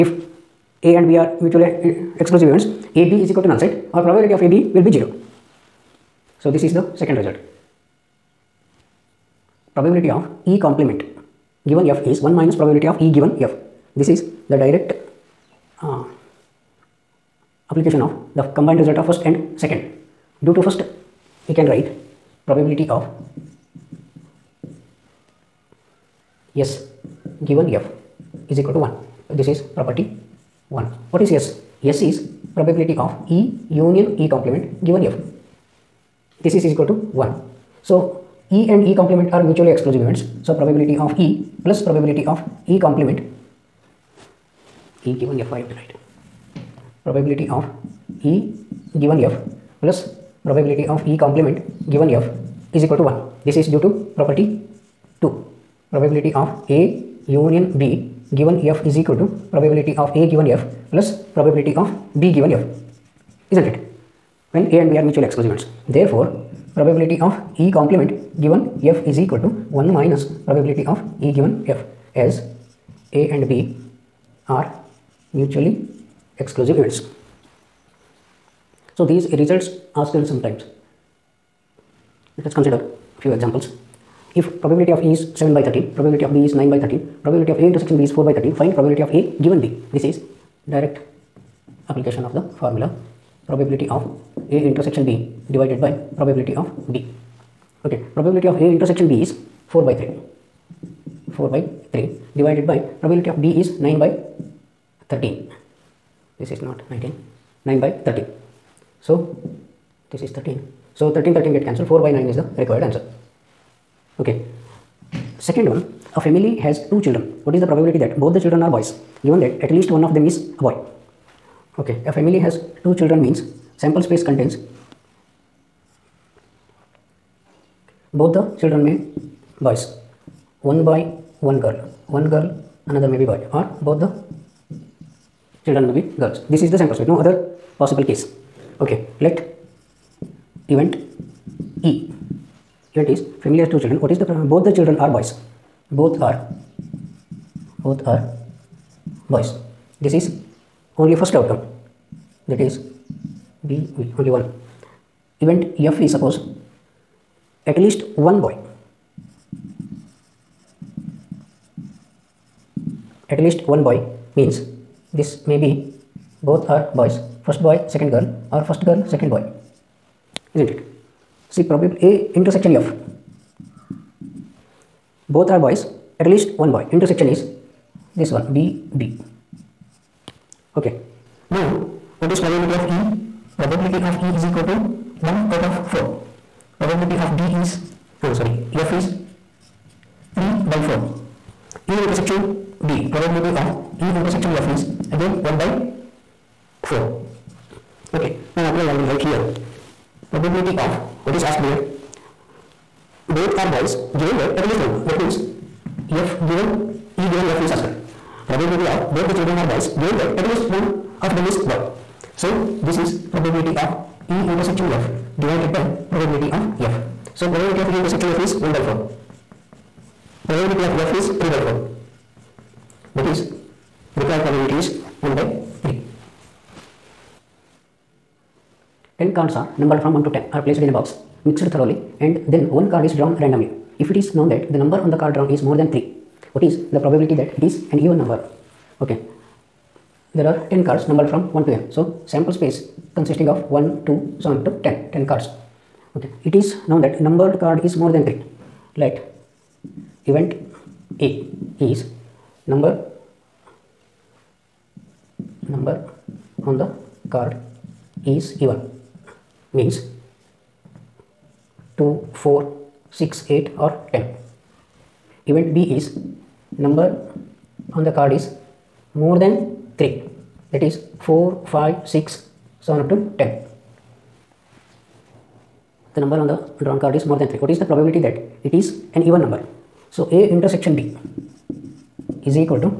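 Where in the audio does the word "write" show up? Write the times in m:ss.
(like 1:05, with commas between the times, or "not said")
0:21, 3:19.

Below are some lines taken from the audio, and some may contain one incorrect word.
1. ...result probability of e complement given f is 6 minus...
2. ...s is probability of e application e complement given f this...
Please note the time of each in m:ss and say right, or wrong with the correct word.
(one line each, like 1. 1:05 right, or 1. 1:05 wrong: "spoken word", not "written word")
1. 0:07 wrong: "1", not "6"
2. 0:31 wrong: "union", not "application".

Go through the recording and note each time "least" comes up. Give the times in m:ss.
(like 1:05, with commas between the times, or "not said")
1:59, 2:37, 2:43, 2:56, 3:24, 3:30.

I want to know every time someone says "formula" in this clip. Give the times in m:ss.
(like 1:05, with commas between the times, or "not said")
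1:32.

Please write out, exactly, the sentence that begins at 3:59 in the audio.
Okay there are 10 cards numbered from 1 to n.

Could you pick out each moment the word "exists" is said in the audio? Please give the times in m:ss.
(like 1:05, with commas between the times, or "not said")
not said.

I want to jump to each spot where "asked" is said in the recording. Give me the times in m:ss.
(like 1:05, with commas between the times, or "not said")
3:21, 3:27.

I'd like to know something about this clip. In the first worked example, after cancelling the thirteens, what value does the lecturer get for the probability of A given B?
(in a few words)
4/9.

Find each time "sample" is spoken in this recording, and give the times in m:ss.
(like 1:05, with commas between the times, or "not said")
2:03, 2:16, 4:02.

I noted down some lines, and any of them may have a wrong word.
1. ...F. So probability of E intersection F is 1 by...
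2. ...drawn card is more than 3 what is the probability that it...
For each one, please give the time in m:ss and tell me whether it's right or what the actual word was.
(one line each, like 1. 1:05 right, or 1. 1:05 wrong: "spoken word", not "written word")
1. 3:36 right
2. 4:36 right.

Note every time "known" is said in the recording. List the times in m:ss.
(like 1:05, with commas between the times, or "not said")
3:54, 4:06.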